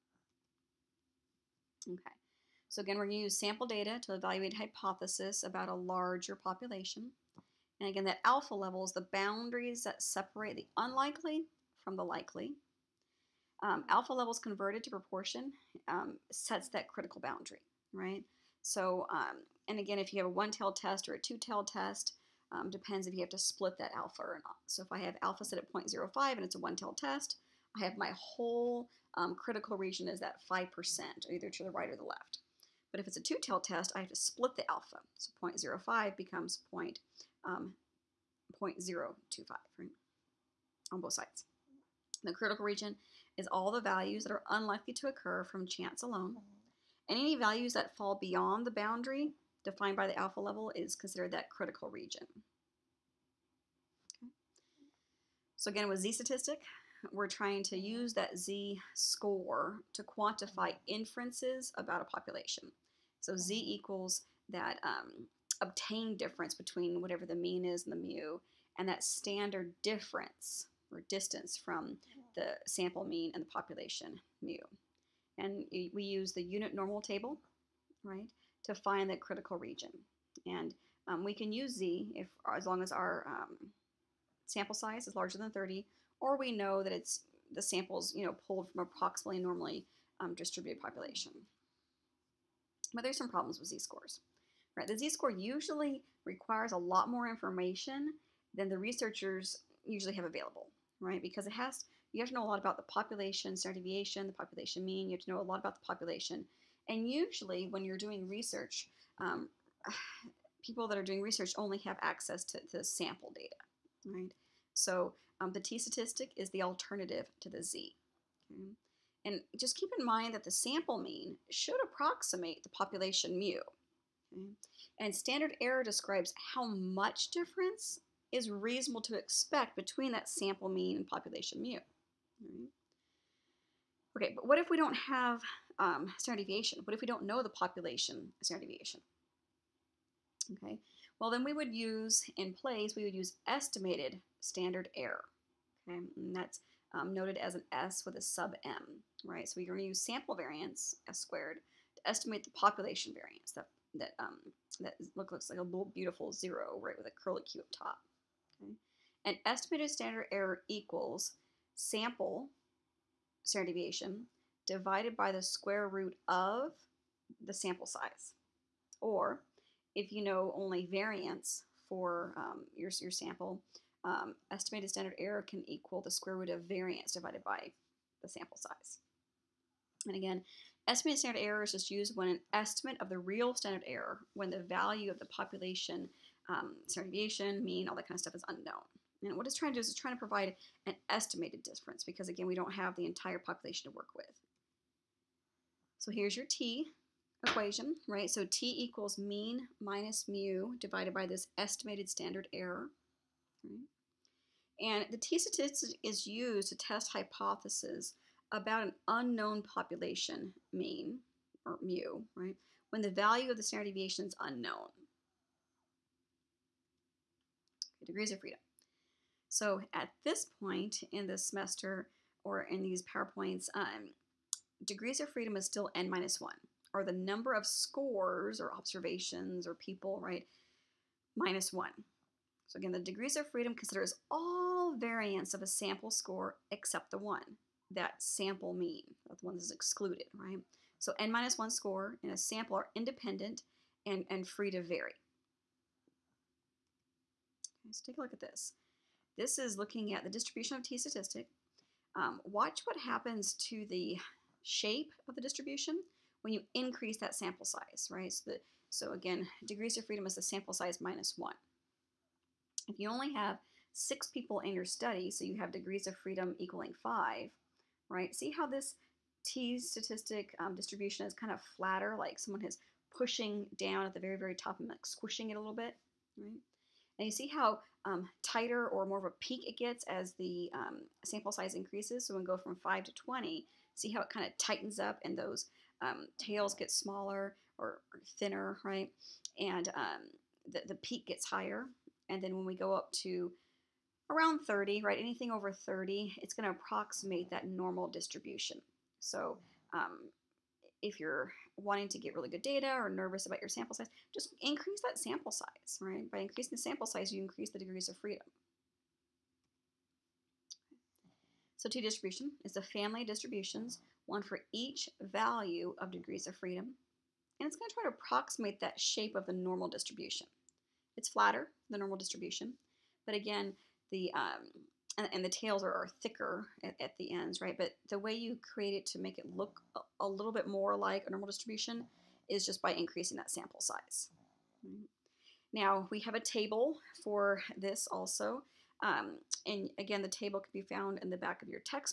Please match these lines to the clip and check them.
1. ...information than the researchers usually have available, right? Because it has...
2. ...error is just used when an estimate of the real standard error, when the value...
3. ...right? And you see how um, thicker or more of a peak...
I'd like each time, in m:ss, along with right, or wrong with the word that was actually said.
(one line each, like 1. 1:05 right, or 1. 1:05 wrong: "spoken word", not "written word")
1. 1:37 right
2. 3:01 right
3. 4:36 wrong: "tighter", not "thicker".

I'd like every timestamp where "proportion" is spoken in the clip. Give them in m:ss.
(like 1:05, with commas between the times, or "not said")
0:14.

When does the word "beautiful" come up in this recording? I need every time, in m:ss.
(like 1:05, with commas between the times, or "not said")
2:35.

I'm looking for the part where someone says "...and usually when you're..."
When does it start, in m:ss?
1:46.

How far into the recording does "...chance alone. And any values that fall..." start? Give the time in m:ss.
0:45.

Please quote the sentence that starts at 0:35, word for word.
So 0.05 becomes point um, 0.025 on both sides.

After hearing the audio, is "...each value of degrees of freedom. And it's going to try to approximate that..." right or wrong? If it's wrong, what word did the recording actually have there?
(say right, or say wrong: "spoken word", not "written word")
right.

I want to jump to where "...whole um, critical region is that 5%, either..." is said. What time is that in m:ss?
0:28.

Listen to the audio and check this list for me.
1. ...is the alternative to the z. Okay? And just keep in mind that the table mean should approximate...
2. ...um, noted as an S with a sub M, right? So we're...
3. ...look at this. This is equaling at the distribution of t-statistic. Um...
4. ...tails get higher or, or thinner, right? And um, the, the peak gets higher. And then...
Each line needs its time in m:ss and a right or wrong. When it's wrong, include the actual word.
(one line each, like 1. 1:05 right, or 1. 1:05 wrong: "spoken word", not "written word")
1. 1:56 wrong: "sample", not "table"
2. 2:26 right
3. 4:08 wrong: "looking", not "equaling"
4. 4:46 wrong: "smaller", not "higher".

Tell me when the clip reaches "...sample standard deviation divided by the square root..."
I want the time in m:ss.
2:41.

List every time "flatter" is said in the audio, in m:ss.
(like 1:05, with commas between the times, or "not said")
4:31, 5:21.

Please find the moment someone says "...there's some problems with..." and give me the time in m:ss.
1:33.